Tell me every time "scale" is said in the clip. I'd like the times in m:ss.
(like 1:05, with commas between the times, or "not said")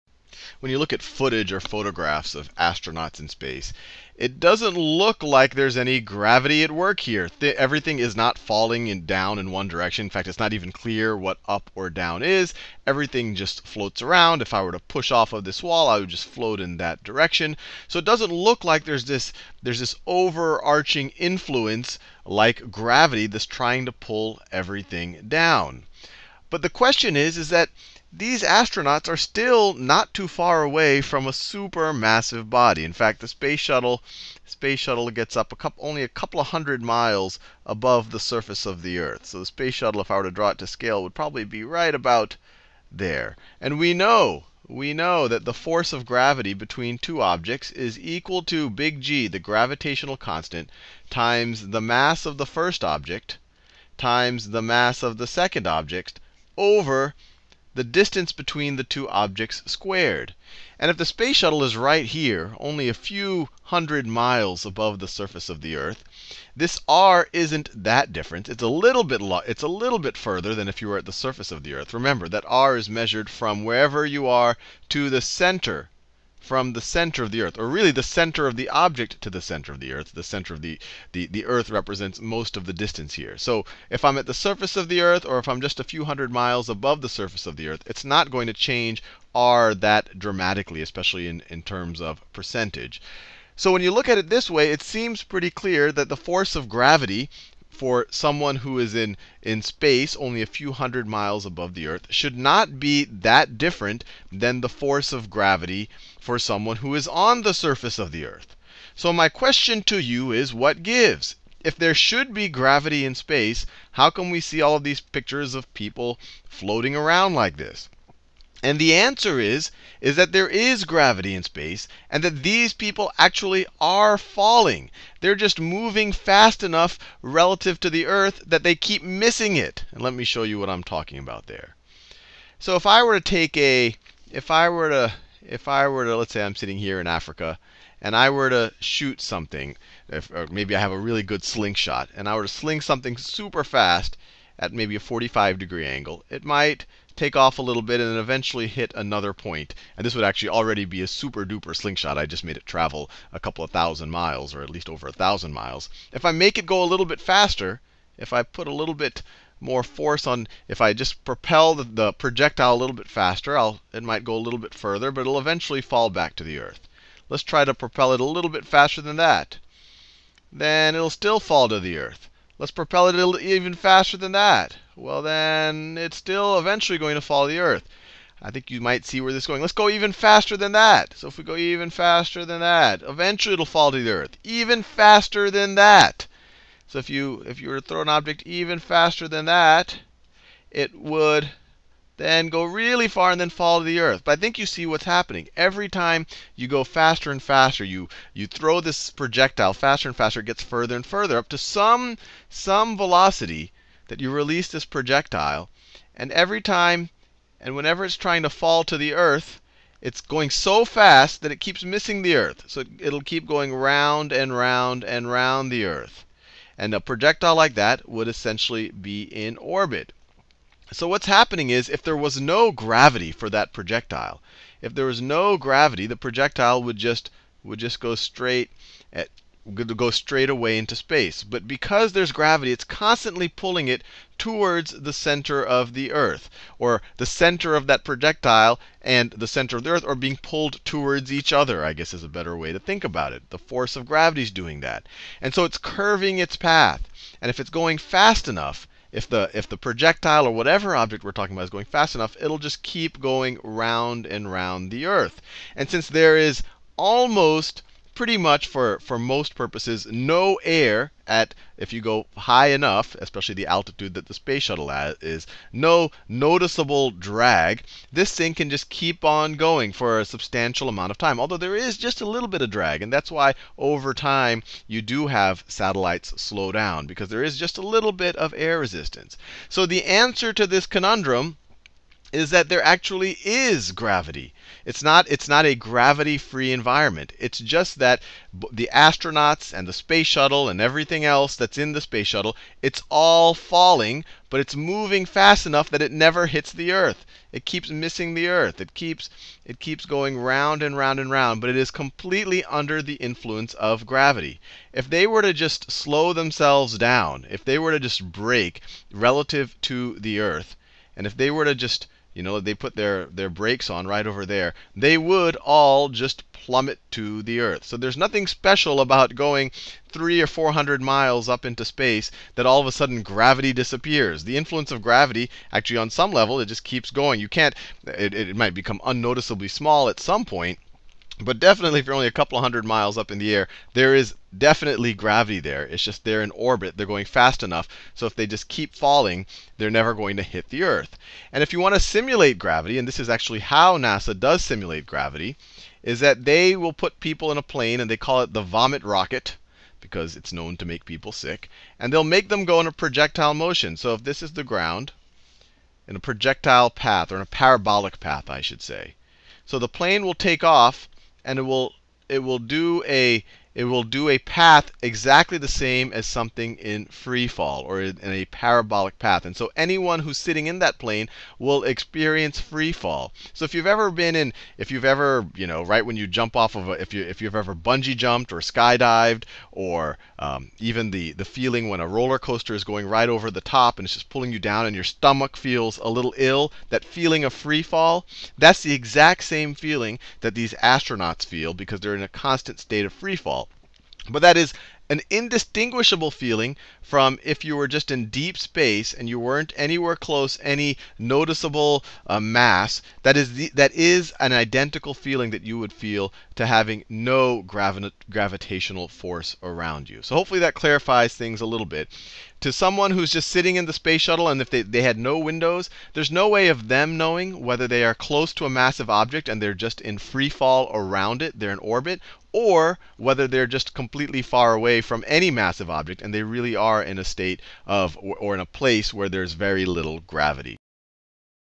0:40.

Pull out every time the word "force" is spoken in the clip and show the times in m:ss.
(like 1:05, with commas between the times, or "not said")
0:45, 1:36, 1:44, 2:39, 4:03, 6:49.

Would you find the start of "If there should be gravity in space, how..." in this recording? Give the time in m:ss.
1:51.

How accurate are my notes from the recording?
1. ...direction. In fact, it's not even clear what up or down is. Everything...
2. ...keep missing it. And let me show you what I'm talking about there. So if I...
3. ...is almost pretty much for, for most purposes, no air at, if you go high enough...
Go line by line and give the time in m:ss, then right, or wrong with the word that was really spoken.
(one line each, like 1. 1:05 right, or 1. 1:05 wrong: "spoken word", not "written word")
1. 0:09 right
2. 2:08 right
3. 4:16 right.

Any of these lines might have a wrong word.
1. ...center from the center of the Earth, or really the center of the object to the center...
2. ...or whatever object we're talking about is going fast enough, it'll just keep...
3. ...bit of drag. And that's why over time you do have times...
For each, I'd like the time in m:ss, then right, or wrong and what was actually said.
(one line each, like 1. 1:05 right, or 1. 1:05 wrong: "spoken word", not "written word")
1. 1:15 right
2. 4:10 right
3. 4:32 wrong: "satellites", not "times".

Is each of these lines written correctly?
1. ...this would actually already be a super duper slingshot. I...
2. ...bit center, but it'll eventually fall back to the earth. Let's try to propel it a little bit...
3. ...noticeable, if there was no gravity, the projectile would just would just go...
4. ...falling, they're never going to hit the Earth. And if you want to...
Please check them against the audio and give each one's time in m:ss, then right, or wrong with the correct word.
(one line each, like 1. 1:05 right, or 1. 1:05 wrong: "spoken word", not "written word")
1. 2:30 right
2. 2:44 wrong: "further", not "center"
3. 3:43 wrong: "projectile", not "noticeable"
4. 5:38 right.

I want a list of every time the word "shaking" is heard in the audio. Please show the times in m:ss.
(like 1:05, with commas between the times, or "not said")
not said.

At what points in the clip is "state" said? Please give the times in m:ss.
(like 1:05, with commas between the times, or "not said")
6:32, 7:07.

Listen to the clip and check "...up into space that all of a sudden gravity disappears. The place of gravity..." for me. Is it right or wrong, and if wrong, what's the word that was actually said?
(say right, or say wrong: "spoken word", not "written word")
wrong: "influence", not "place".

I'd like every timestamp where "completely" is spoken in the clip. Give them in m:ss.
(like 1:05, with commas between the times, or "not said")
5:01, 7:03.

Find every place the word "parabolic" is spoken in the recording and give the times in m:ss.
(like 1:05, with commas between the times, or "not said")
5:57, 6:08.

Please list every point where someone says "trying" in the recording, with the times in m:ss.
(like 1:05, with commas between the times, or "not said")
0:23, 3:28.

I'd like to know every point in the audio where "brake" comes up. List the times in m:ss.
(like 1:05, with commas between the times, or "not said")
5:08, 5:13.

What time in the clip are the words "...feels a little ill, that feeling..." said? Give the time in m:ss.
6:25.